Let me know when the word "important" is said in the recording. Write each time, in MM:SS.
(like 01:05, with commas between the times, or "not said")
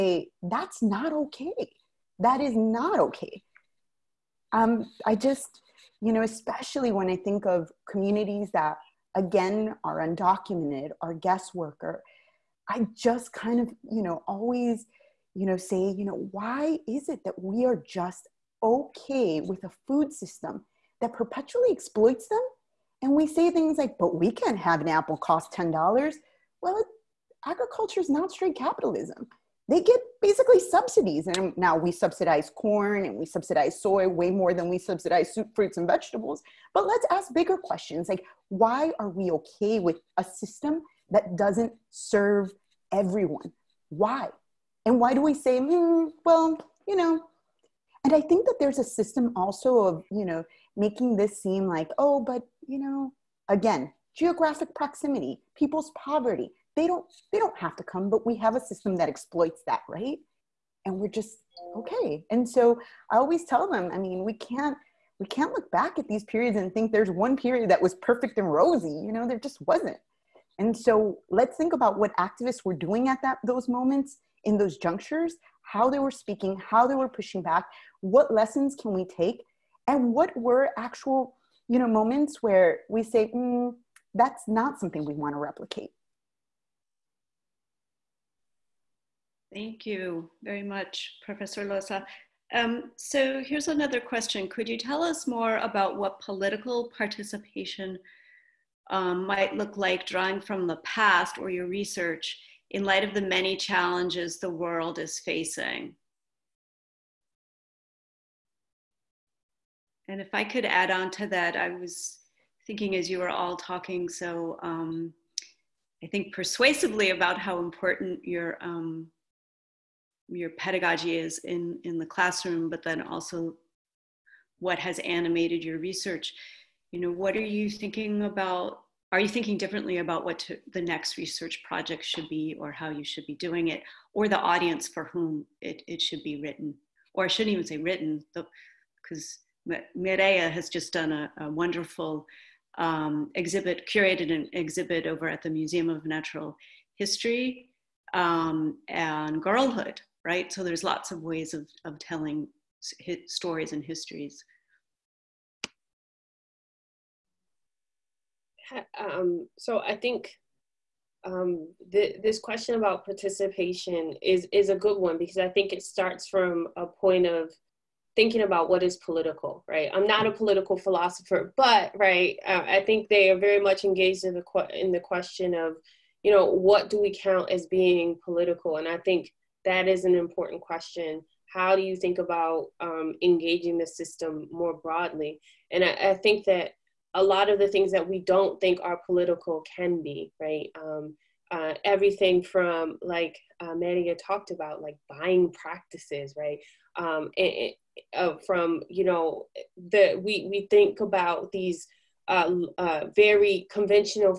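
01:57, 03:00.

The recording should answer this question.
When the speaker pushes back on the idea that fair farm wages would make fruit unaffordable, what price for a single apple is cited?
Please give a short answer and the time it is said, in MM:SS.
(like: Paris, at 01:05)
$10, at 00:25.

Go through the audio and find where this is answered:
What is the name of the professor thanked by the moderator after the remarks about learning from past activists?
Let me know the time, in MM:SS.
01:31.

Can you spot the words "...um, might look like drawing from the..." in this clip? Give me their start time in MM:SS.
01:38.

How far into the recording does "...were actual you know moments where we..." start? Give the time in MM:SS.
01:20.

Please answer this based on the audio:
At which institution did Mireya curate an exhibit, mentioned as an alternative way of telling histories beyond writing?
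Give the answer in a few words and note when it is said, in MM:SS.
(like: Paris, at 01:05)
Museum of Natural History, at 02:25.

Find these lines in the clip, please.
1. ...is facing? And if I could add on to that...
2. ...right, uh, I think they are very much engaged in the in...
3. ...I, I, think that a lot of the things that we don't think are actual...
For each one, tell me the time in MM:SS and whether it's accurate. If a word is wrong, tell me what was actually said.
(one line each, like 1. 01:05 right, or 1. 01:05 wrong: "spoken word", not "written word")
1. 01:44 right
2. 02:52 right
3. 03:05 wrong: "political", not "actual".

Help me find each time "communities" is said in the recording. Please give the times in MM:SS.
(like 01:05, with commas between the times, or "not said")
00:07.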